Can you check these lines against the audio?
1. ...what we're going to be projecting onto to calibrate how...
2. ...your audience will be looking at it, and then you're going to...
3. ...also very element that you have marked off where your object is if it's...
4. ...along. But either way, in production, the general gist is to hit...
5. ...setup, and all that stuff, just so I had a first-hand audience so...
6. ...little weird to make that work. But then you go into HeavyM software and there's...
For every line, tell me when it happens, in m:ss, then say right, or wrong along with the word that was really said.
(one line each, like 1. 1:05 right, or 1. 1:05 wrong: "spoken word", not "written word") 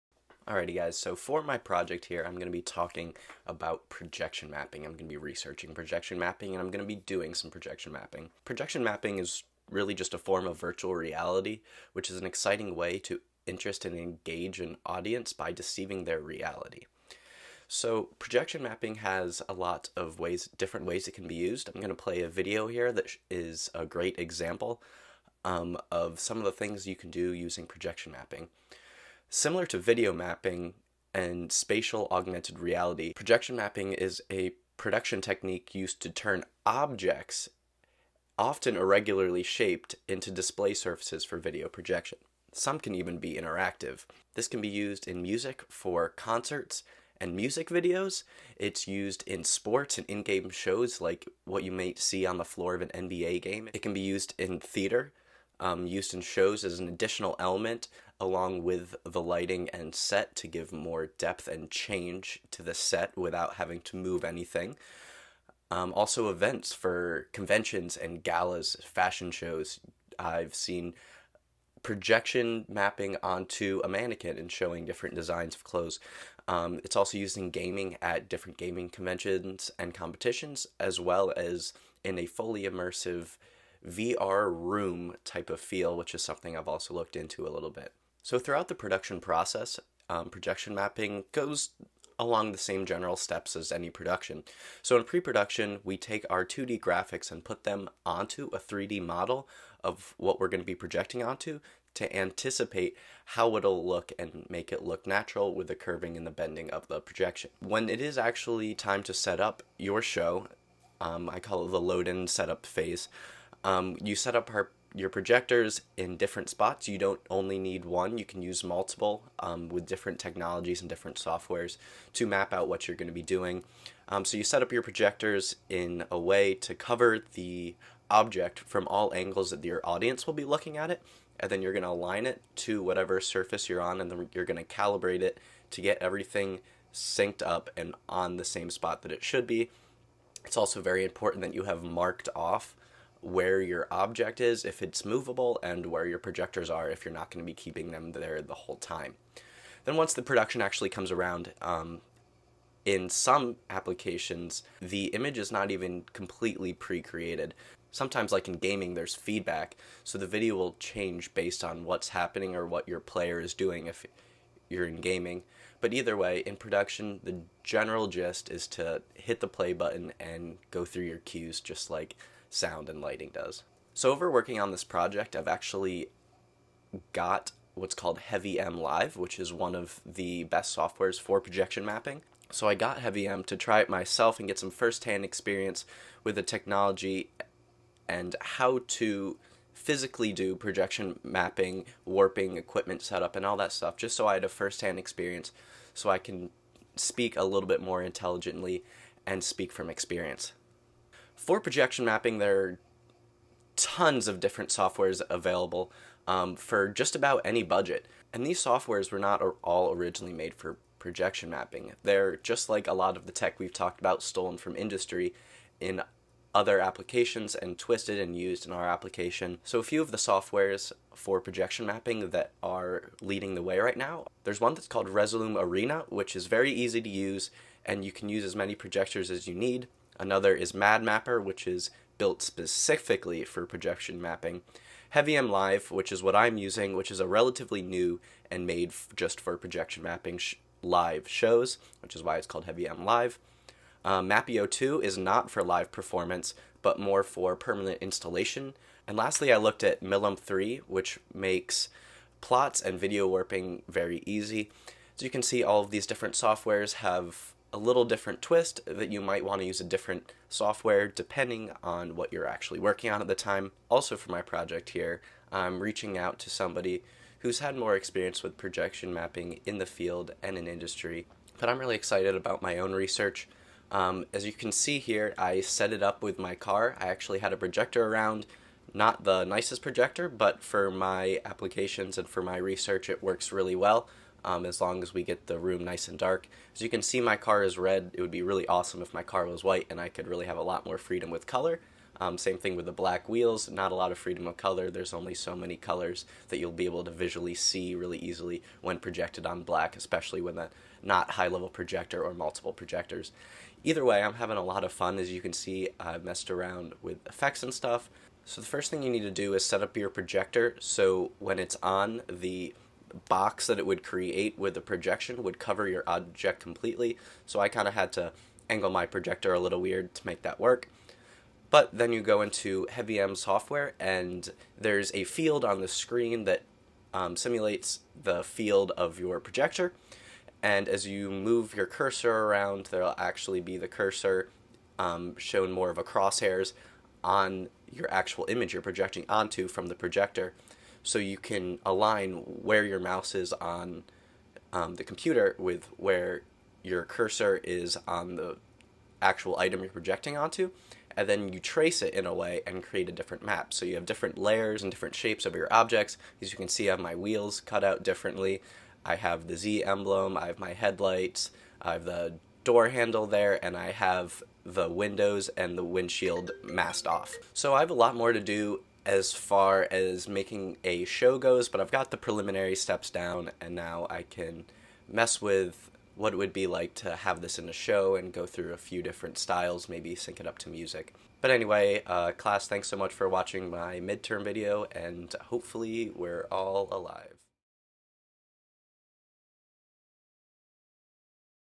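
1. 1:40 wrong: "anticipate", not "calibrate"
2. 2:09 right
3. 2:20 wrong: "important", not "element"
4. 2:45 wrong: "gaming", not "along"
5. 3:13 wrong: "experience", not "audience"
6. 5:19 right.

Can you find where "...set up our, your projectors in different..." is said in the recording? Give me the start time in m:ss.
1:54.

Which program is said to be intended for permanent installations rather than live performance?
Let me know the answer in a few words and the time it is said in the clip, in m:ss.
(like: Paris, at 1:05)
Mapio 2, at 4:04.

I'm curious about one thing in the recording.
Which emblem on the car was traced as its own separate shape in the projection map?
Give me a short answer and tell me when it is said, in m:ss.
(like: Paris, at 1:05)
the Z emblem, at 5:59.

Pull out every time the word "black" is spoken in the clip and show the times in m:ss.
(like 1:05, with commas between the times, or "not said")
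4:52, 4:59.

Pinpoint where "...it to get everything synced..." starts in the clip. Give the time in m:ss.
2:15.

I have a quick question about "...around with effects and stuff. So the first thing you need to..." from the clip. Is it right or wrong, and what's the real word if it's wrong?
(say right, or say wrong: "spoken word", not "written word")
right.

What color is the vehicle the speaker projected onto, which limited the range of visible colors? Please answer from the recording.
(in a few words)
red.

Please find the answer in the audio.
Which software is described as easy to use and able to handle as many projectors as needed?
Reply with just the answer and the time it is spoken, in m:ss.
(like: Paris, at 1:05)
Resolume Arena, at 3:45.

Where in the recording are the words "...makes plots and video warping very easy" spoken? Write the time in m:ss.
4:11.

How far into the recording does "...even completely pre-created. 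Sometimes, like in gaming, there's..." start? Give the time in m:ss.
2:35.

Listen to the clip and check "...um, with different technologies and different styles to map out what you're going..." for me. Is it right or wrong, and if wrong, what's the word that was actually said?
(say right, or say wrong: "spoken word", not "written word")
wrong: "softwares", not "styles".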